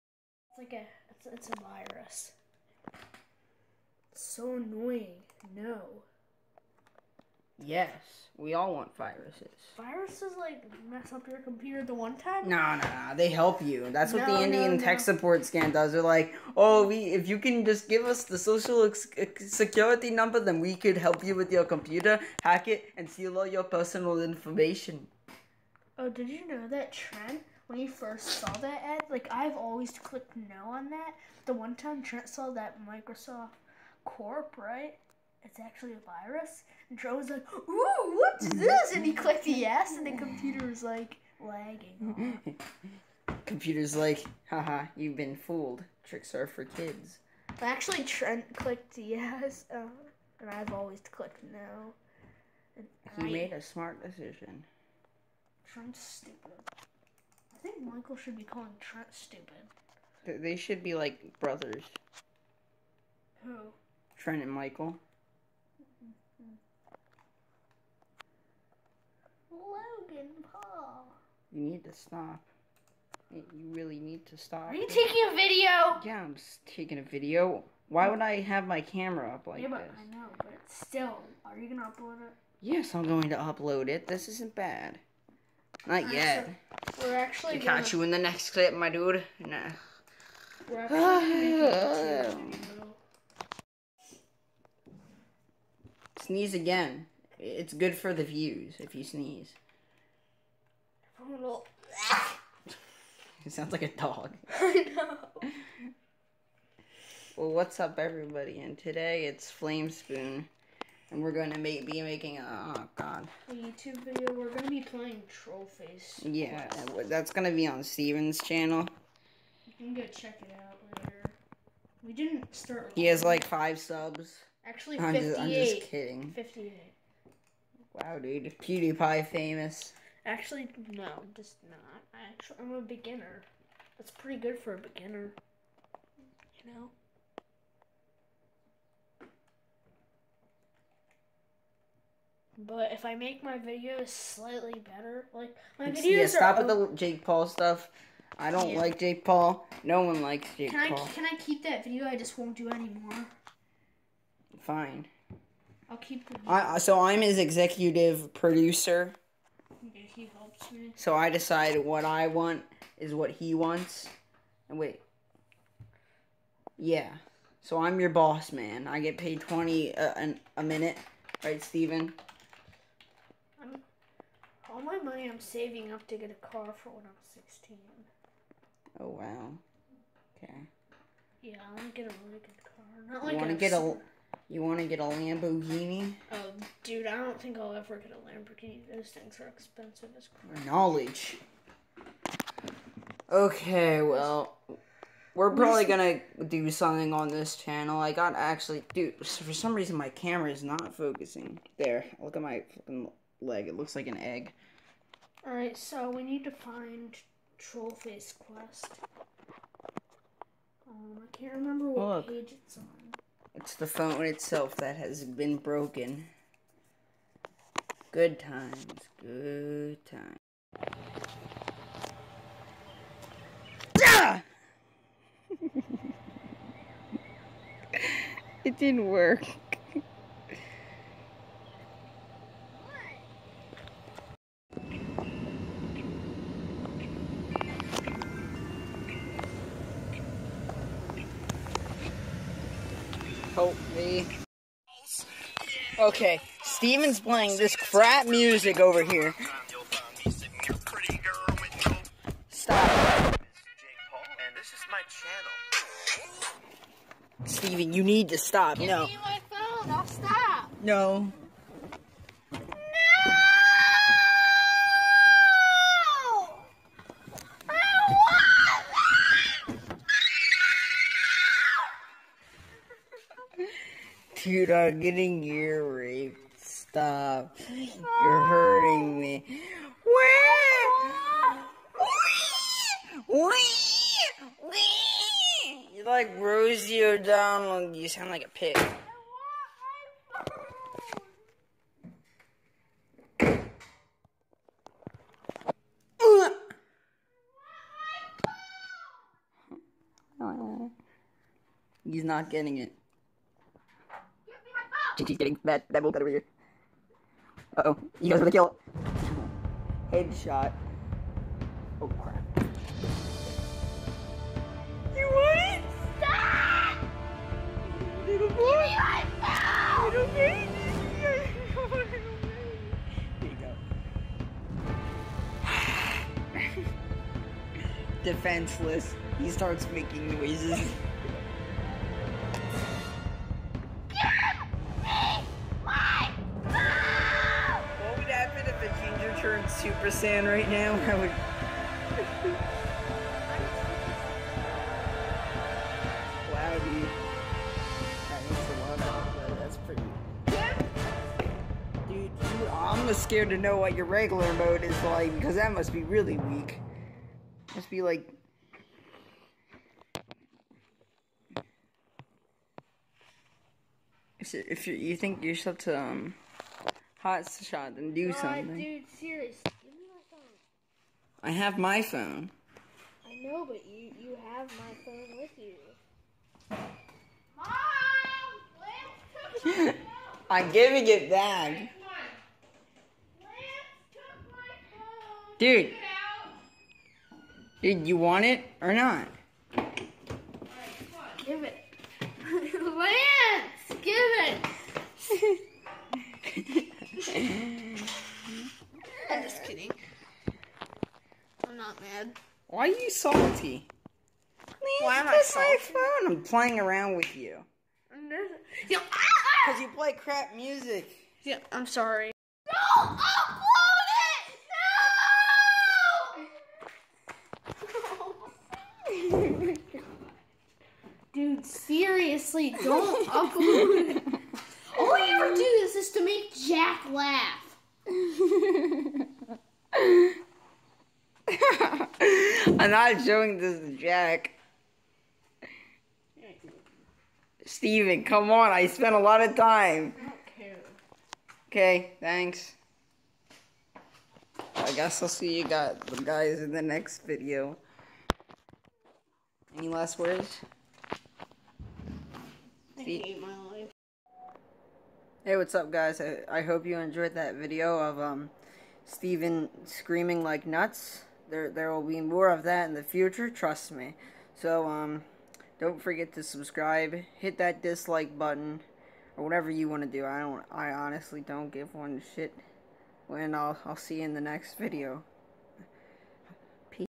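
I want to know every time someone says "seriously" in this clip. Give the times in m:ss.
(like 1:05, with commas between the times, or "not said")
6:09, 7:01.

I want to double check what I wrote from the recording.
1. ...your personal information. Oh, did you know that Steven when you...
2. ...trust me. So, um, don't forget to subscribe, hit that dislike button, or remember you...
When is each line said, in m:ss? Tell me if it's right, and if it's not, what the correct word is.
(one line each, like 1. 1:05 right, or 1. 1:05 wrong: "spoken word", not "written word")
1. 0:23 wrong: "Trent", not "Steven"
2. 7:43 wrong: "whatever", not "remember".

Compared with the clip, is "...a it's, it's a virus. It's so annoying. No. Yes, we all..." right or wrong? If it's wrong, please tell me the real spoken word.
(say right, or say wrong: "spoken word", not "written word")
right.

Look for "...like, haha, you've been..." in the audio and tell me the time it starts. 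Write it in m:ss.
0:43.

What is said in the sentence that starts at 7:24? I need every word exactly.
I guess I'll see you guys in the next video.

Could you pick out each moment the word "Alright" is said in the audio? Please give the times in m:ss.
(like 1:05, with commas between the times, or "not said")
3:25.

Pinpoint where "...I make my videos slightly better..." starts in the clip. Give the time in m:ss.
2:23.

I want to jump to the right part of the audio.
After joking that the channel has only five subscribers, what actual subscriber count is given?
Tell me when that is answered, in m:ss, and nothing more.
2:04.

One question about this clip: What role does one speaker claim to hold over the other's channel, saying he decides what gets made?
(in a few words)
Executive producer.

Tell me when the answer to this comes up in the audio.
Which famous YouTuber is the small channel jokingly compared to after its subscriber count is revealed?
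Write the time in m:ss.
2:08.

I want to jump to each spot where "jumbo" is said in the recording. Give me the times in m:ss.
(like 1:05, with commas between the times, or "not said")
not said.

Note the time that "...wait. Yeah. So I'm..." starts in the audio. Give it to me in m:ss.
2:44.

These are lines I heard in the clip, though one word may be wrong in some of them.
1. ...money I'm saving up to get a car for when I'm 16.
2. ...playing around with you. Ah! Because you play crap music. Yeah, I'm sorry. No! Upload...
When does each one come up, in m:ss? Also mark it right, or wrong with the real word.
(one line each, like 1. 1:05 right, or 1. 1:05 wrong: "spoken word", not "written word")
1. 2:54 right
2. 6:46 right.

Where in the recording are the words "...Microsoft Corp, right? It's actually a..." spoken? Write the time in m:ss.
0:32.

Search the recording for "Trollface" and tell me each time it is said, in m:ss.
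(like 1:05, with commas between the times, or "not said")
1:55, 3:27.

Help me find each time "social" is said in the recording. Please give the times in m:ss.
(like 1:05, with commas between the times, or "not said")
0:18.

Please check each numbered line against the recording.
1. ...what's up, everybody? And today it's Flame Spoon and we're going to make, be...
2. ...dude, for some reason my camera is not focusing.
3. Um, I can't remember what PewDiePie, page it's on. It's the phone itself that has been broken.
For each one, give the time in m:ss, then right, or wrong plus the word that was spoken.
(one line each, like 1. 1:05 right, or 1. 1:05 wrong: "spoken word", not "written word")
1. 1:47 right
2. 3:18 right
3. 3:30 wrong: "Look", not "PewDiePie".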